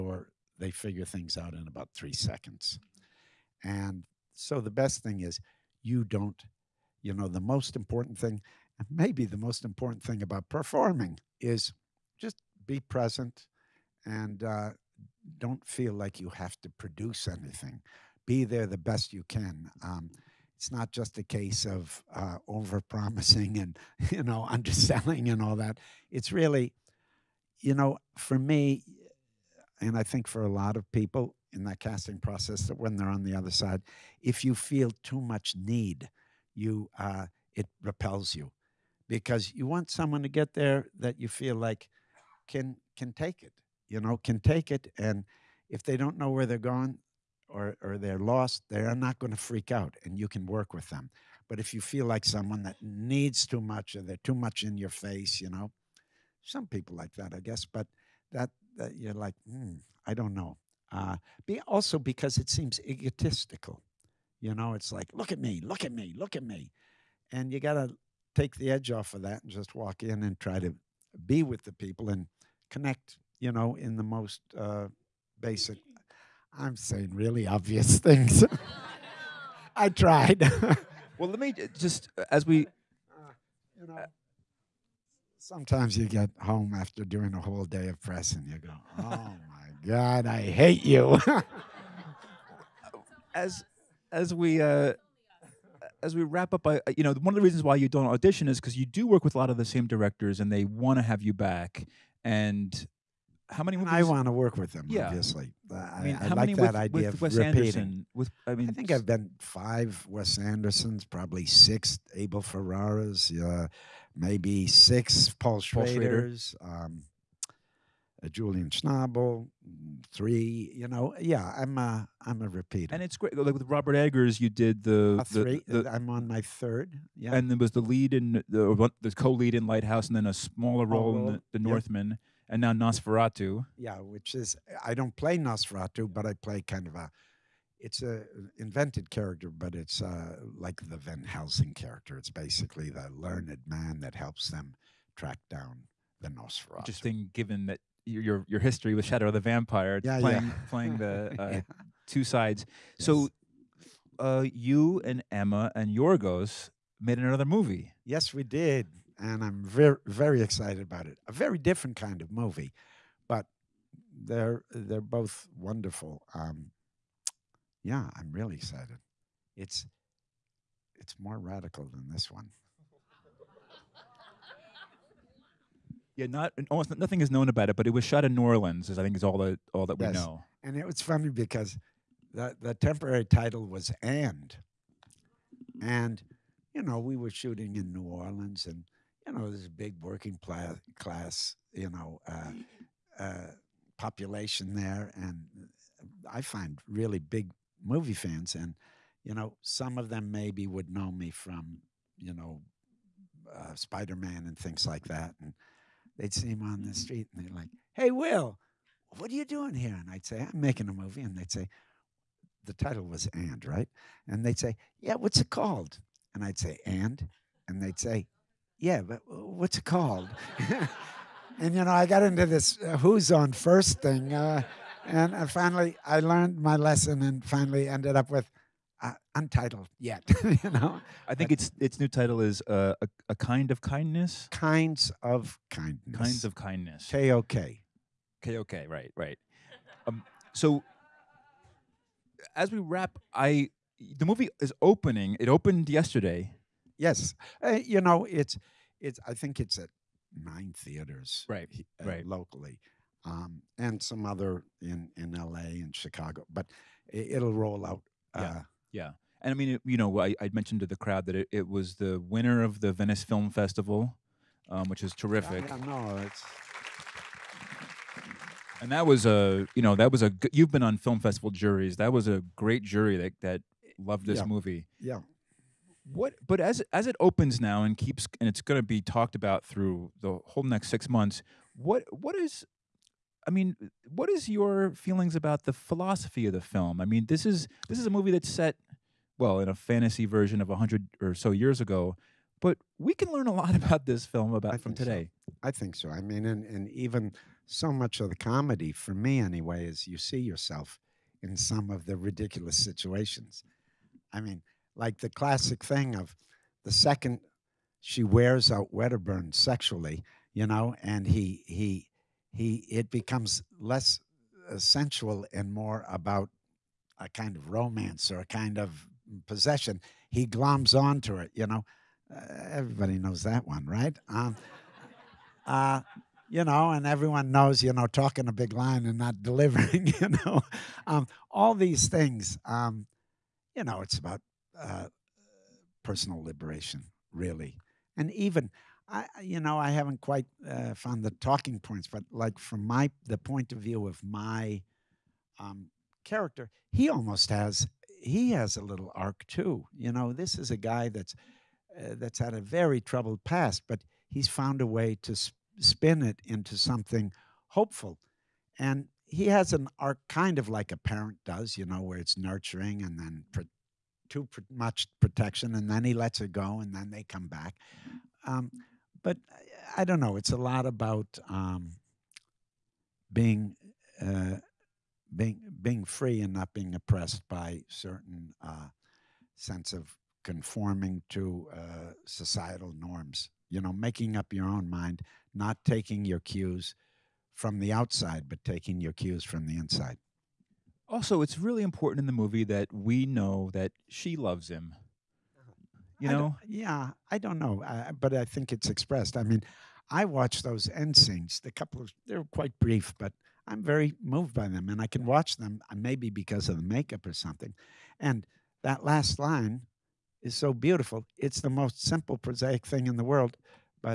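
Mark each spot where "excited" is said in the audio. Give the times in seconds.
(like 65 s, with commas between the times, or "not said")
160 s, 168 s.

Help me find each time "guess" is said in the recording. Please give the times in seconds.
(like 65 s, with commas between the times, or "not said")
57 s.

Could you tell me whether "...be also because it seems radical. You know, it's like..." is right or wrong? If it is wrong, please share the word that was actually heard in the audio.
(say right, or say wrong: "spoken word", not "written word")
wrong: "egotistical", not "radical".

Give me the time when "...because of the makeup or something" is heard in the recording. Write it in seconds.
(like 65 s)
406 s.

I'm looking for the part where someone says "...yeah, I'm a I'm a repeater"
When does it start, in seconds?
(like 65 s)
121 s.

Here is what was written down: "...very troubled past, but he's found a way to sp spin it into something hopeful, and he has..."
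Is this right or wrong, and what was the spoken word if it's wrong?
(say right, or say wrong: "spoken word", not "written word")
right.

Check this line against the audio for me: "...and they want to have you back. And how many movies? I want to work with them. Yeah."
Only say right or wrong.
right.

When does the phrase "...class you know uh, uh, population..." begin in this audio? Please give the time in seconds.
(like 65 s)
190 s.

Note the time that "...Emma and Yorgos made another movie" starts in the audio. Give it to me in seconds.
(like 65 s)
155 s.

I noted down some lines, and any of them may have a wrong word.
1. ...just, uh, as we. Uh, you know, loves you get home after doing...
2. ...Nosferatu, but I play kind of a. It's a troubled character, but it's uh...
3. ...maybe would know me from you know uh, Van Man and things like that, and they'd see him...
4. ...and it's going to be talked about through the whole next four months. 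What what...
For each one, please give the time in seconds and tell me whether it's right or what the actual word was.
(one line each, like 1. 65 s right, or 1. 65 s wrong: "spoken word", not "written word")
1. 81 s wrong: "sometimes", not "loves"
2. 135 s wrong: "invented", not "troubled"
3. 200 s wrong: "Spider", not "Van"
4. 278 s wrong: "six", not "four".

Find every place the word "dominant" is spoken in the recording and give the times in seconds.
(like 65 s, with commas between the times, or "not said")
not said.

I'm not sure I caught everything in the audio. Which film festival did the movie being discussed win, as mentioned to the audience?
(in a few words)
Venice Film Festival.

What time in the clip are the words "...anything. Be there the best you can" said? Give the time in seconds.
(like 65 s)
17 s.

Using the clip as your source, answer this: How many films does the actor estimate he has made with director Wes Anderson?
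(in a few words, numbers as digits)
5.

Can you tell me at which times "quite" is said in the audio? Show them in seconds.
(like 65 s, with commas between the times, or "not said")
340 s, 402 s.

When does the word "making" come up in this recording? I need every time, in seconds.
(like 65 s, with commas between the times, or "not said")
210 s, 383 s.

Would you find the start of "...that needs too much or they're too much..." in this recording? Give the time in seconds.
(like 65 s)
52 s.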